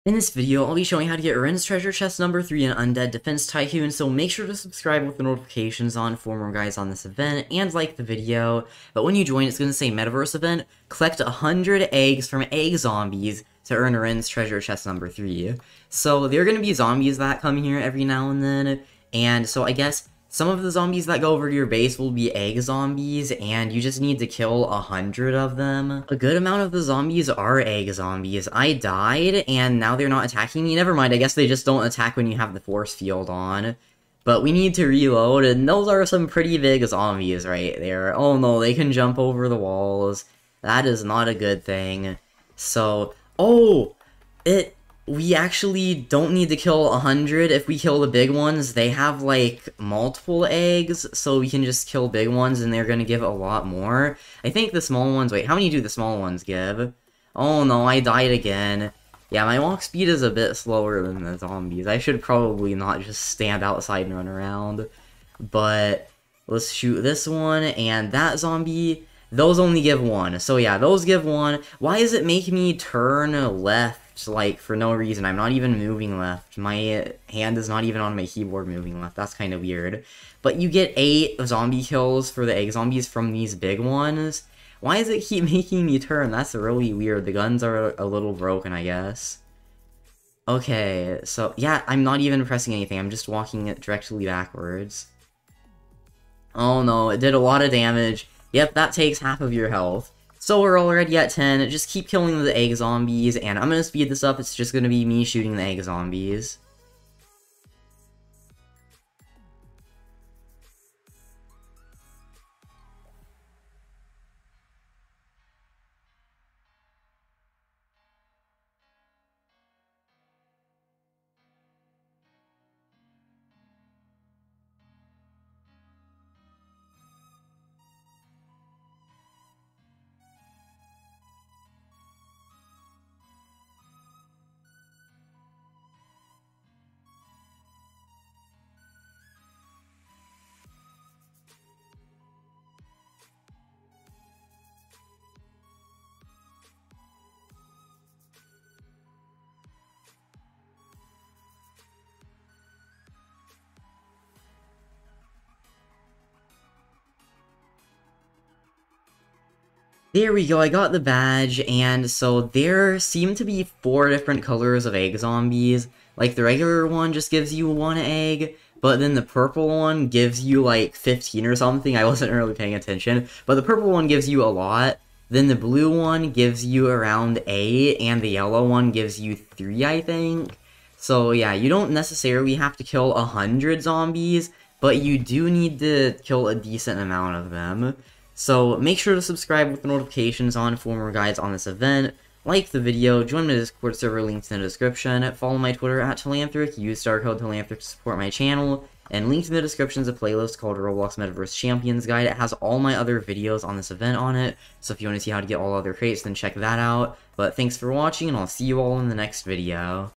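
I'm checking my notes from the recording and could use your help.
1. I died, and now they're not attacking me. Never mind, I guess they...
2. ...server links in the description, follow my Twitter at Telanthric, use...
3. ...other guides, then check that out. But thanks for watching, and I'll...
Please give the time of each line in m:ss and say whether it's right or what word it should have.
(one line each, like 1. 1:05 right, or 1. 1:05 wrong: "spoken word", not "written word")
1. 0:28 right
2. 3:13 right
3. 3:25 wrong: "crates", not "guides".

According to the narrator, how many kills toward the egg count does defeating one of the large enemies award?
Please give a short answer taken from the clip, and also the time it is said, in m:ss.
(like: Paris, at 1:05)
8, at 1:20.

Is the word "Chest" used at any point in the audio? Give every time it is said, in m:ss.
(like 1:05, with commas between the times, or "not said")
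0:01, 0:14.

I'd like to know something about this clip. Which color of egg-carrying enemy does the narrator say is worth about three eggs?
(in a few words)
Yellow.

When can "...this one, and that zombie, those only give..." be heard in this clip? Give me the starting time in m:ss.
1:07.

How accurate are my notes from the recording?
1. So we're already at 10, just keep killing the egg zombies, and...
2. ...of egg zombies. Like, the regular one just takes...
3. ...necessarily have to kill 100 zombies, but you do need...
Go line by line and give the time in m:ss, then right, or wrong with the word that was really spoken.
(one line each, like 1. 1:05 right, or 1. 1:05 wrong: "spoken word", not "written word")
1. 1:40 right
2. 2:44 wrong: "gives", not "takes"
3. 3:01 right.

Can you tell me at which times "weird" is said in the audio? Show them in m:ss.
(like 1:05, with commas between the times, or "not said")
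1:19, 1:26.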